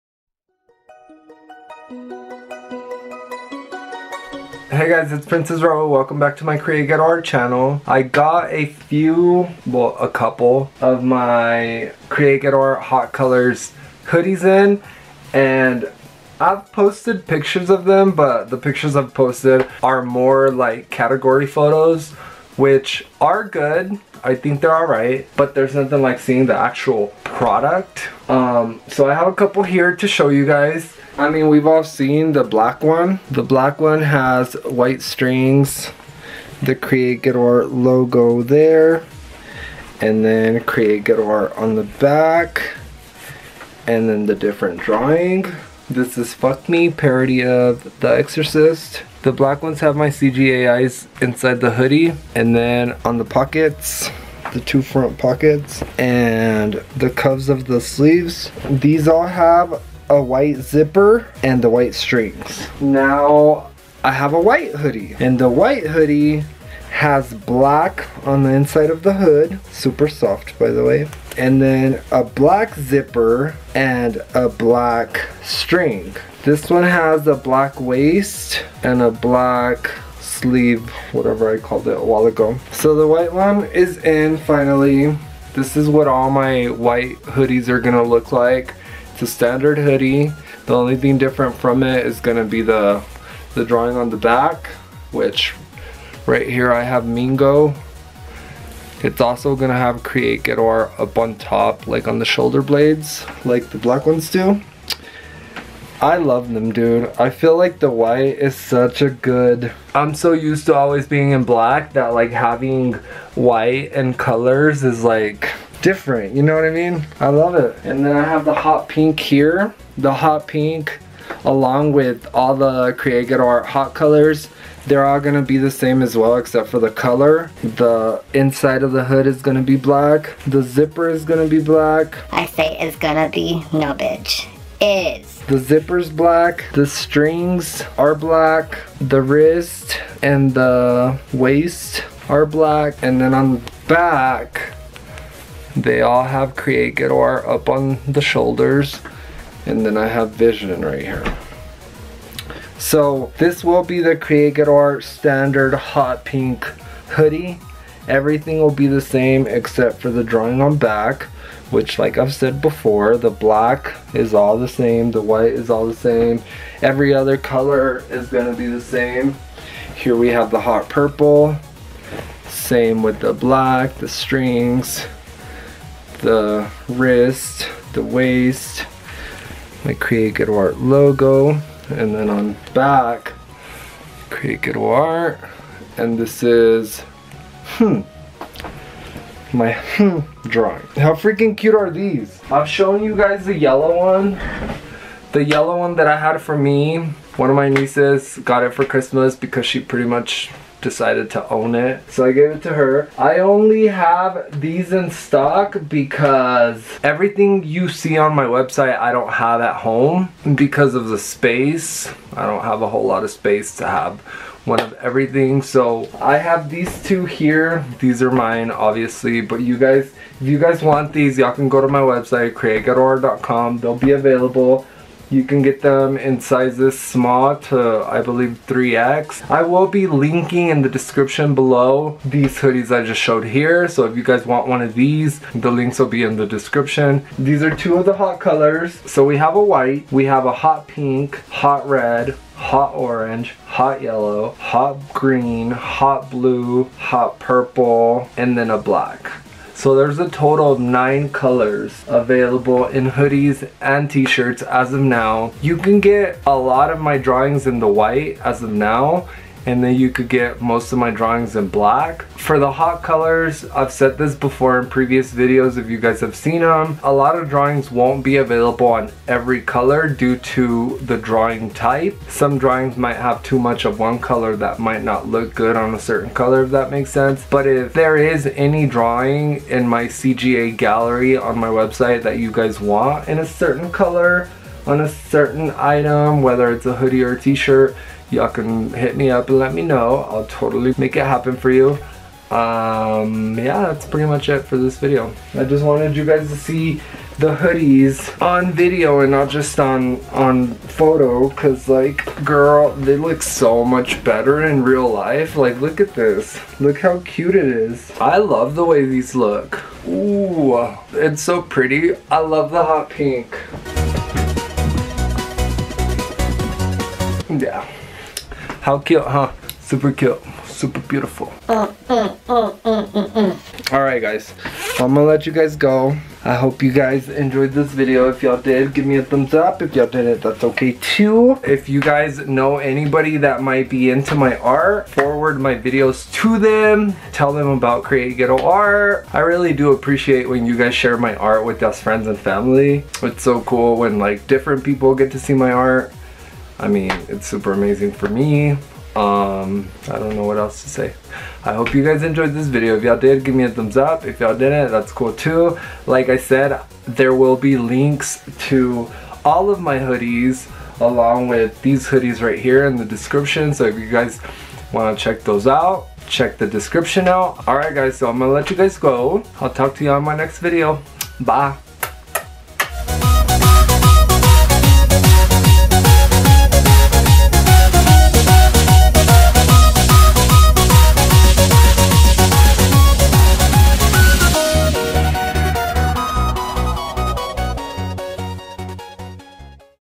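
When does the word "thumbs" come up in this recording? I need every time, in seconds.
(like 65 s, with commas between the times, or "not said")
329 s, 353 s.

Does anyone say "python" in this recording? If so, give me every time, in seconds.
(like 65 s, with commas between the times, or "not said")
not said.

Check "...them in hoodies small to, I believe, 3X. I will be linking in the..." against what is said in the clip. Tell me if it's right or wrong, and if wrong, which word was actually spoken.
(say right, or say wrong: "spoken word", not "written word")
wrong: "sizes", not "hoodies".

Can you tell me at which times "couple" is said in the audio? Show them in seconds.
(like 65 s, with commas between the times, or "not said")
10 s, 29 s.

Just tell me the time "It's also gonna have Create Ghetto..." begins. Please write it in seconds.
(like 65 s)
99 s.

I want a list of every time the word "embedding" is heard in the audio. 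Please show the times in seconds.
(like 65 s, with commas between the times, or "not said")
not said.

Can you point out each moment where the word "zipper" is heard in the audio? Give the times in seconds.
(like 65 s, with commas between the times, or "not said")
60 s, 72 s, 130 s, 135 s.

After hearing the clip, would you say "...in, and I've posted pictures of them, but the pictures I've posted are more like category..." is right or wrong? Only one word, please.
right.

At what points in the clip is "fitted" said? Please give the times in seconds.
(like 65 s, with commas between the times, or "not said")
not said.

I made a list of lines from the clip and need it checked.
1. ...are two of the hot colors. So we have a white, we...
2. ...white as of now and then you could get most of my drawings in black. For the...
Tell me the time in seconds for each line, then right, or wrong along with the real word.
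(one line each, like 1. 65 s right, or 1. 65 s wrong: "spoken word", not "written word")
1. 237 s right
2. 257 s right.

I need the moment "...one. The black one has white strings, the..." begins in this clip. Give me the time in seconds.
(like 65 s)
32 s.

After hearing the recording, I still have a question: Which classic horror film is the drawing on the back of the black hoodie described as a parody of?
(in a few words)
The Exorcist.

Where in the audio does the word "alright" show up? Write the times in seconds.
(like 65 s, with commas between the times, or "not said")
24 s, 367 s.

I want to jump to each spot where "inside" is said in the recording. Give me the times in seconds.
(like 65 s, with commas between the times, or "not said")
51 s, 68 s, 128 s.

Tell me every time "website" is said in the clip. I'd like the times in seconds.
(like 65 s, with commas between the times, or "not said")
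208 s, 222 s, 281 s.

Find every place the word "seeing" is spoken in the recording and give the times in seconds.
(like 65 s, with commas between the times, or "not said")
26 s.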